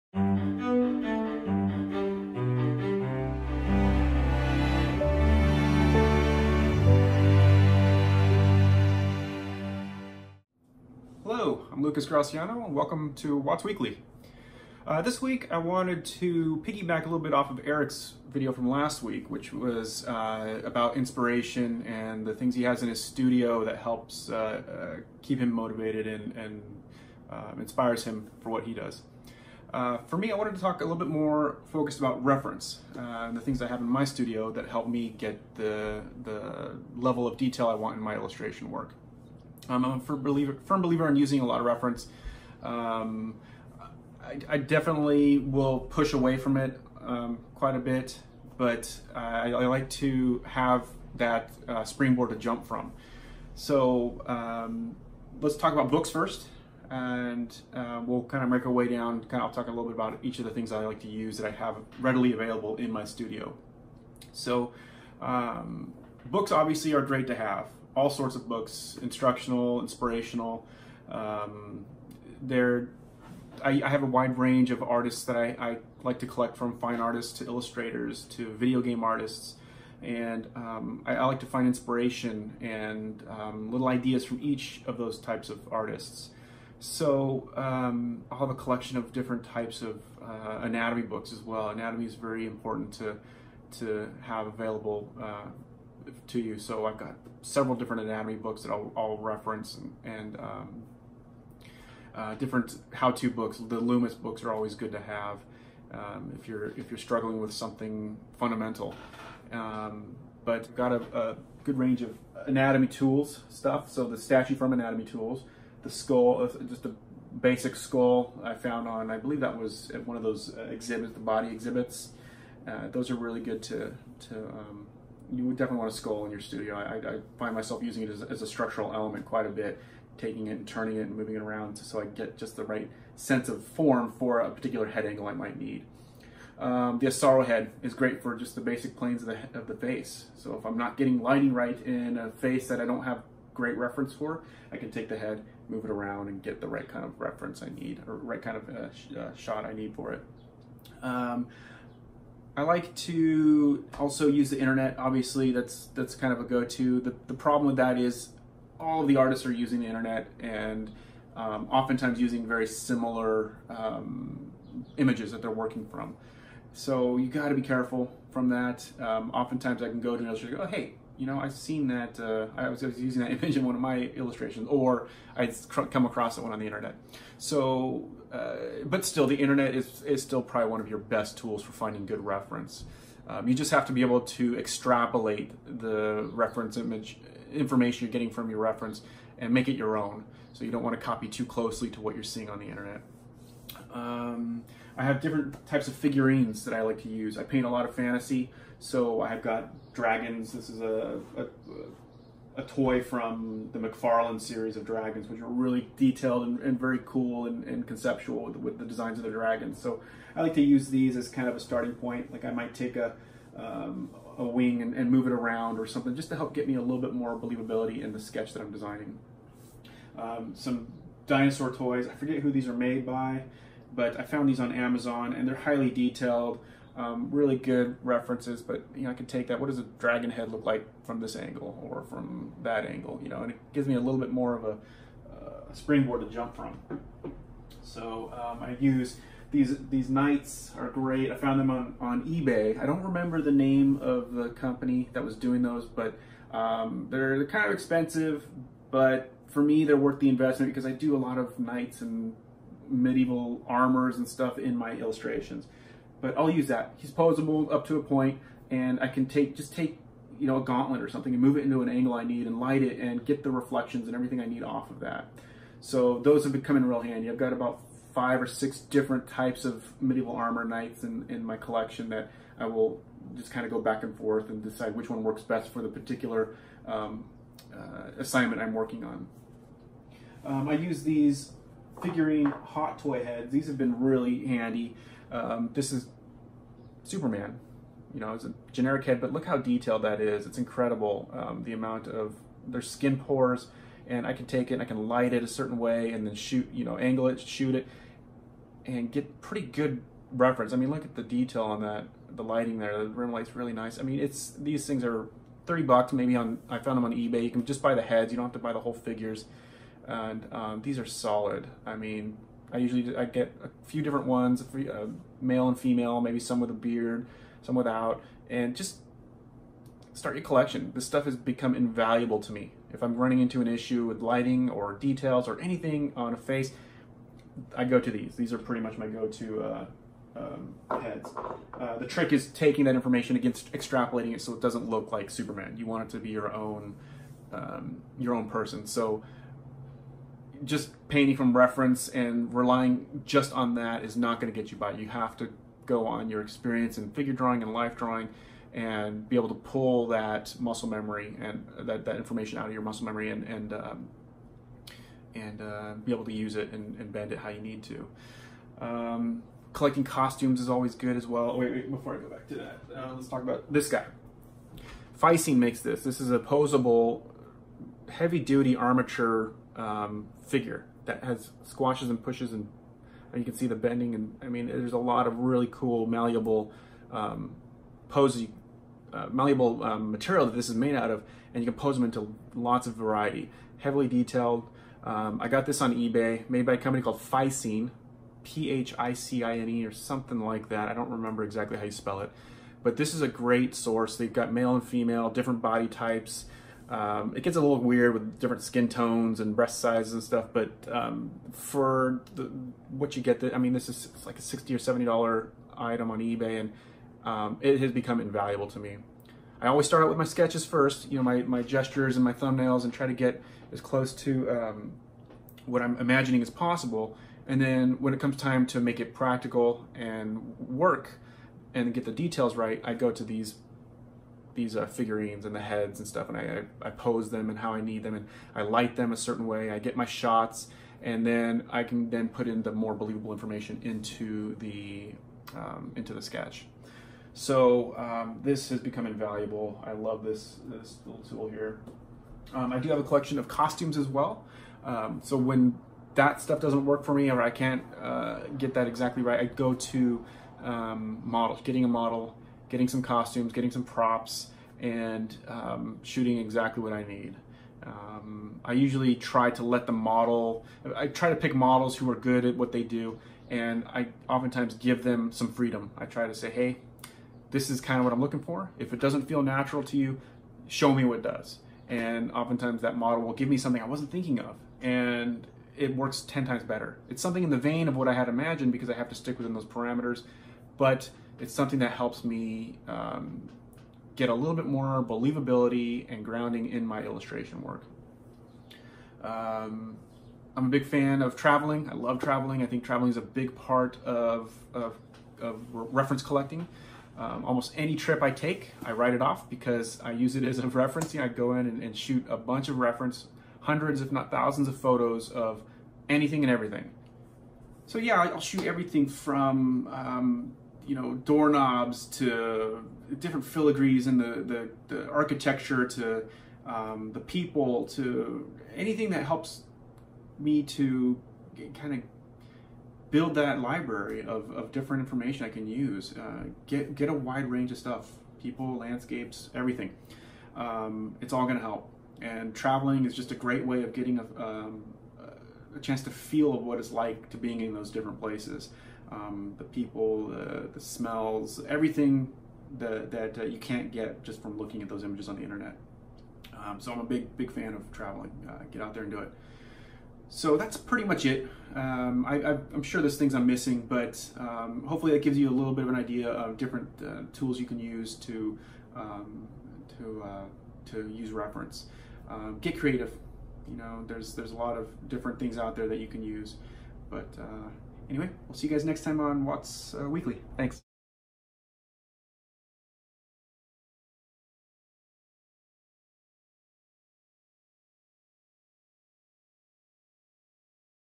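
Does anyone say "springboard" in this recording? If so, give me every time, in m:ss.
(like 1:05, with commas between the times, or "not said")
0:51, 3:55.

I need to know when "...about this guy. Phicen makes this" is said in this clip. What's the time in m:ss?
6:03.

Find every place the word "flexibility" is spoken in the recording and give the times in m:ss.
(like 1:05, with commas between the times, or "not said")
not said.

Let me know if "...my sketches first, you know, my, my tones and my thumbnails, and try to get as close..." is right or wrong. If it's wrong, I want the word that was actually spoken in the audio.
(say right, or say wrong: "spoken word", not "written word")
wrong: "gestures", not "tones".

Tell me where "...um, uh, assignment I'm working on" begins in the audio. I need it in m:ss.
4:36.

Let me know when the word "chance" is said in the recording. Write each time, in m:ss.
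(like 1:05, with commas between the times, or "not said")
8:55.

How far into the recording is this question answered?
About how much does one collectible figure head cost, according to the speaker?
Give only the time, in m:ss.
5:05.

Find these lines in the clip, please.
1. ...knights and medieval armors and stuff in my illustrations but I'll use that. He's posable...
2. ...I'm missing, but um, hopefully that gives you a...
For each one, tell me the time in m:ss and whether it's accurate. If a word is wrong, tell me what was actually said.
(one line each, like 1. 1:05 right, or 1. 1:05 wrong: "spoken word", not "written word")
1. 4:11 right
2. 9:13 right.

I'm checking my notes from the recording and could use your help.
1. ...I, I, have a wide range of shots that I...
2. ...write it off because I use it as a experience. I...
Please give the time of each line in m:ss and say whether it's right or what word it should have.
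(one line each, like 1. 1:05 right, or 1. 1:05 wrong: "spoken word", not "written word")
1. 1:13 wrong: "artists", not "shots"
2. 8:18 wrong: "reference", not "experience".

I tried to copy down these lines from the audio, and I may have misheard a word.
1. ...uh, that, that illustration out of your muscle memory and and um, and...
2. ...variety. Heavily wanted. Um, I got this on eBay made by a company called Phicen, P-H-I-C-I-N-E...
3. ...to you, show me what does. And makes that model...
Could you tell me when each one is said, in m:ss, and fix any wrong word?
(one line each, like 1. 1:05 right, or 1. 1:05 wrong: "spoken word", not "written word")
1. 5:51 wrong: "information", not "illustration"
2. 6:22 wrong: "detailed", not "wanted"
3. 7:49 wrong: "oftentimes", not "makes".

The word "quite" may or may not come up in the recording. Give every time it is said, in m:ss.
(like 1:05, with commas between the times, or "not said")
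0:47, 2:09.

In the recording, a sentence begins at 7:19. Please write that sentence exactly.
I love this this little tool here.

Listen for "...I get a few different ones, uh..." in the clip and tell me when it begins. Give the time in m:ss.
5:13.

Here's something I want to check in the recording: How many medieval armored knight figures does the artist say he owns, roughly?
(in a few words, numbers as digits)
5 or 6.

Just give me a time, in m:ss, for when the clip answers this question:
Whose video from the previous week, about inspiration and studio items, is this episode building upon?
0:17.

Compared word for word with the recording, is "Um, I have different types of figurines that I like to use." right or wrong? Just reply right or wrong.
right.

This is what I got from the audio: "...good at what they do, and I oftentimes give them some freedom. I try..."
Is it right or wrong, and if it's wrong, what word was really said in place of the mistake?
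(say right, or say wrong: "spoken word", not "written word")
right.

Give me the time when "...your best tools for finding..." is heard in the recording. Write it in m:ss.
3:00.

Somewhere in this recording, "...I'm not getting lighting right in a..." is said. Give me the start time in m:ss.
2:20.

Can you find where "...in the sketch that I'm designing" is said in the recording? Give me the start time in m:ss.
3:38.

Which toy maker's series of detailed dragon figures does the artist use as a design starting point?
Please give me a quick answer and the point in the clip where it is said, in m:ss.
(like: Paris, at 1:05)
McFarlane, at 3:23.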